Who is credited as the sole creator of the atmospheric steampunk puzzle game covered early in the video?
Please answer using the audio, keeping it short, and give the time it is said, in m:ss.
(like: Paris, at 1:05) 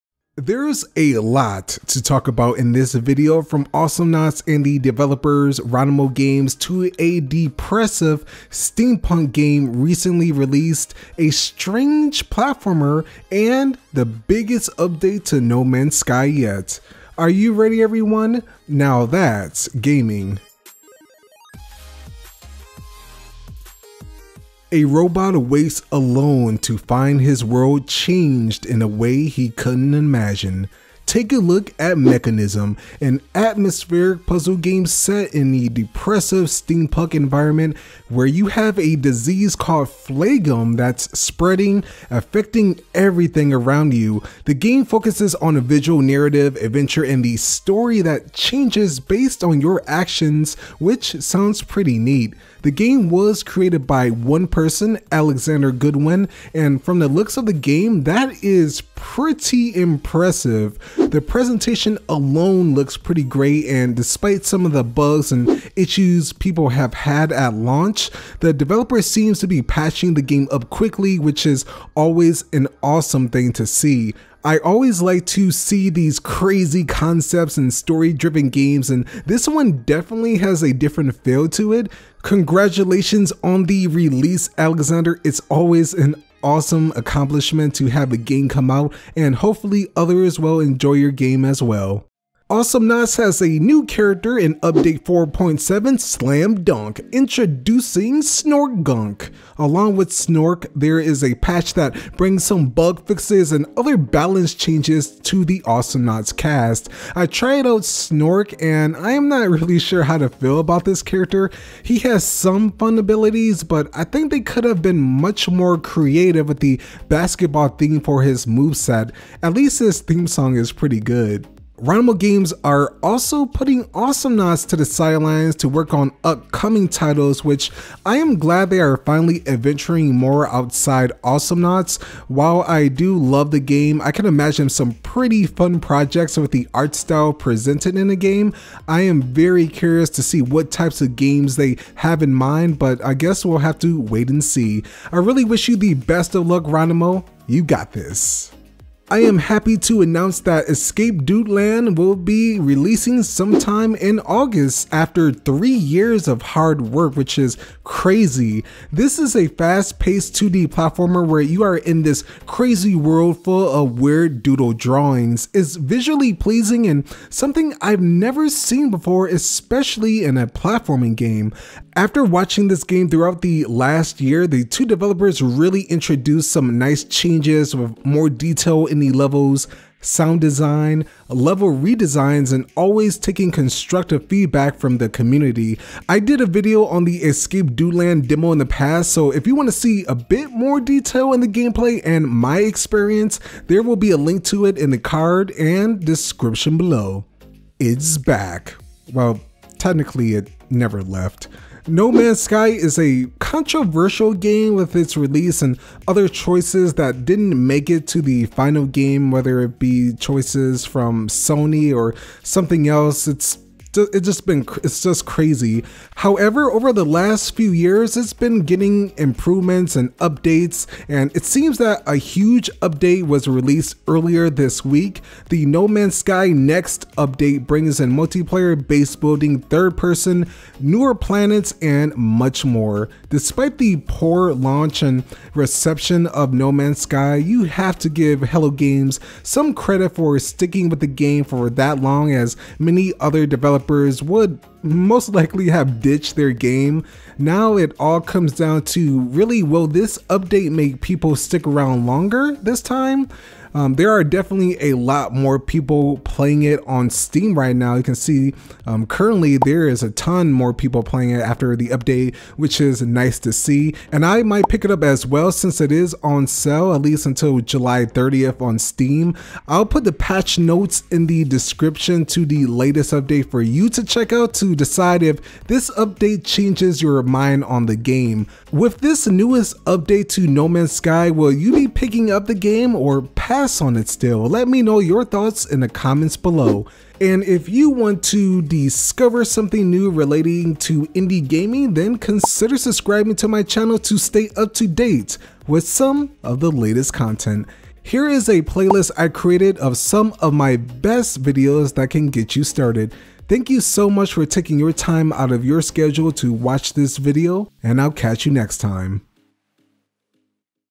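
Alexander Goodwin, at 0:55.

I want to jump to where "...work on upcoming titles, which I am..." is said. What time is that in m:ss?
2:05.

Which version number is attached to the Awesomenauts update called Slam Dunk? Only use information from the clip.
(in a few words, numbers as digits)
4.7.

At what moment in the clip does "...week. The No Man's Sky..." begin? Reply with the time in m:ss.
3:44.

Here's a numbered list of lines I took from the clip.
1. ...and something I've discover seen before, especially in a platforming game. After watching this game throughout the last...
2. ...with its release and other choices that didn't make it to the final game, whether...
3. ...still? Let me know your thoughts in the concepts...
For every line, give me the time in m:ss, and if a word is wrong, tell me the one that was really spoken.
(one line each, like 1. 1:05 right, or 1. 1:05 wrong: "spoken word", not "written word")
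1. 2:46 wrong: "never", not "discover"
2. 3:24 right
3. 4:44 wrong: "comments", not "concepts".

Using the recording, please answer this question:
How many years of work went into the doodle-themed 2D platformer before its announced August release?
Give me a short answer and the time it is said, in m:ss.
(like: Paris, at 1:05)
3, at 2:35.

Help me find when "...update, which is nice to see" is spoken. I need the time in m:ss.
4:21.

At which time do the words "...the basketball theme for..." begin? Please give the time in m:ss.
1:56.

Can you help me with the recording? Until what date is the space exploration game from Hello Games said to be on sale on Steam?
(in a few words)
July 30th.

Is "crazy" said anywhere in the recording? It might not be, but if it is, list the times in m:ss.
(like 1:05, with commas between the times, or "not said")
1:16, 2:37, 2:42, 3:35.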